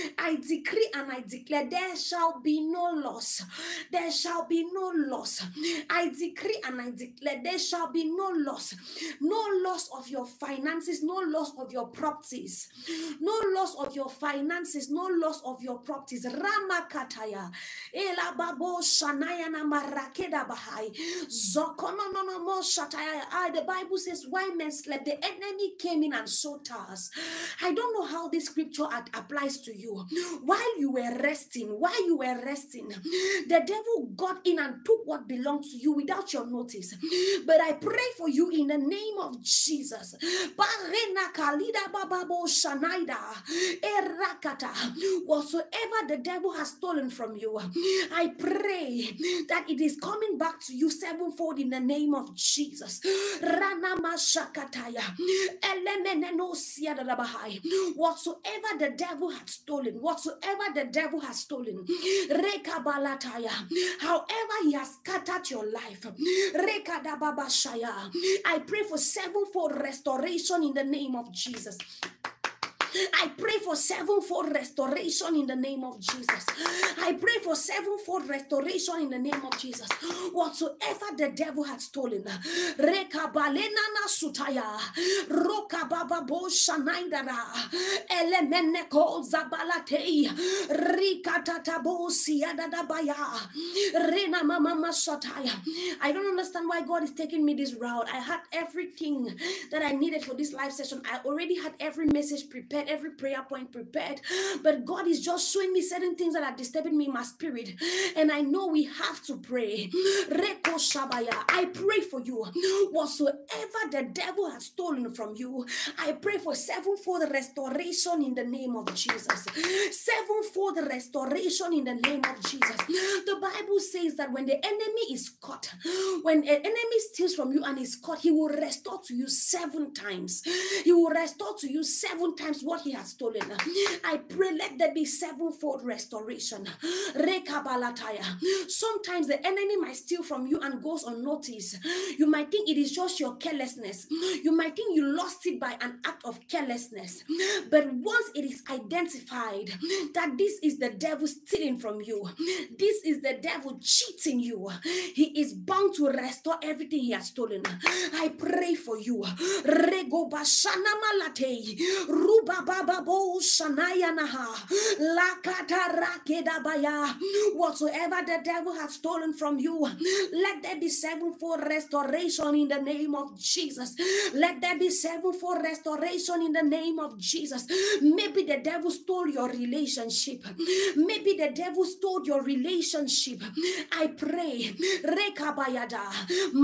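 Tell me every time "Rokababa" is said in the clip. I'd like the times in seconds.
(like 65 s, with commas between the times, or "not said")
85 s.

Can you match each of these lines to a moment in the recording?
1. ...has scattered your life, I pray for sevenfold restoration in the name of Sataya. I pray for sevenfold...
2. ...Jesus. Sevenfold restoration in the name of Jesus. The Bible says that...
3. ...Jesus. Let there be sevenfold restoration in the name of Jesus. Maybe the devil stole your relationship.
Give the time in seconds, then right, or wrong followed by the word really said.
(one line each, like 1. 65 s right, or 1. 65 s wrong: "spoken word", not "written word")
1. 64 s wrong: "Jesus", not "Sataya"
2. 118 s right
3. 173 s right.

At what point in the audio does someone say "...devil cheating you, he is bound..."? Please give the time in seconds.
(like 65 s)
153 s.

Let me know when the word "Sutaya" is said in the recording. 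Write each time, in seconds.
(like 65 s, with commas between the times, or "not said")
84 s.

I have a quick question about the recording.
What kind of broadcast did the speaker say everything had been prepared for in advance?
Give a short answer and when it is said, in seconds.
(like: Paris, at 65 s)
live session, at 100 s.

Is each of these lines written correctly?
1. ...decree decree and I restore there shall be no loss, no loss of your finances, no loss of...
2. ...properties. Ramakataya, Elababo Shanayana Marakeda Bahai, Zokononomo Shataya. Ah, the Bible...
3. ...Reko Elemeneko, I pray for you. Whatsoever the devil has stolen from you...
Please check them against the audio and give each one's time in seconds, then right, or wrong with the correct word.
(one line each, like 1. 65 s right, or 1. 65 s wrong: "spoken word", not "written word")
1. 6 s wrong: "declare", not "restore"
2. 15 s right
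3. 110 s wrong: "Shabaya", not "Elemeneko".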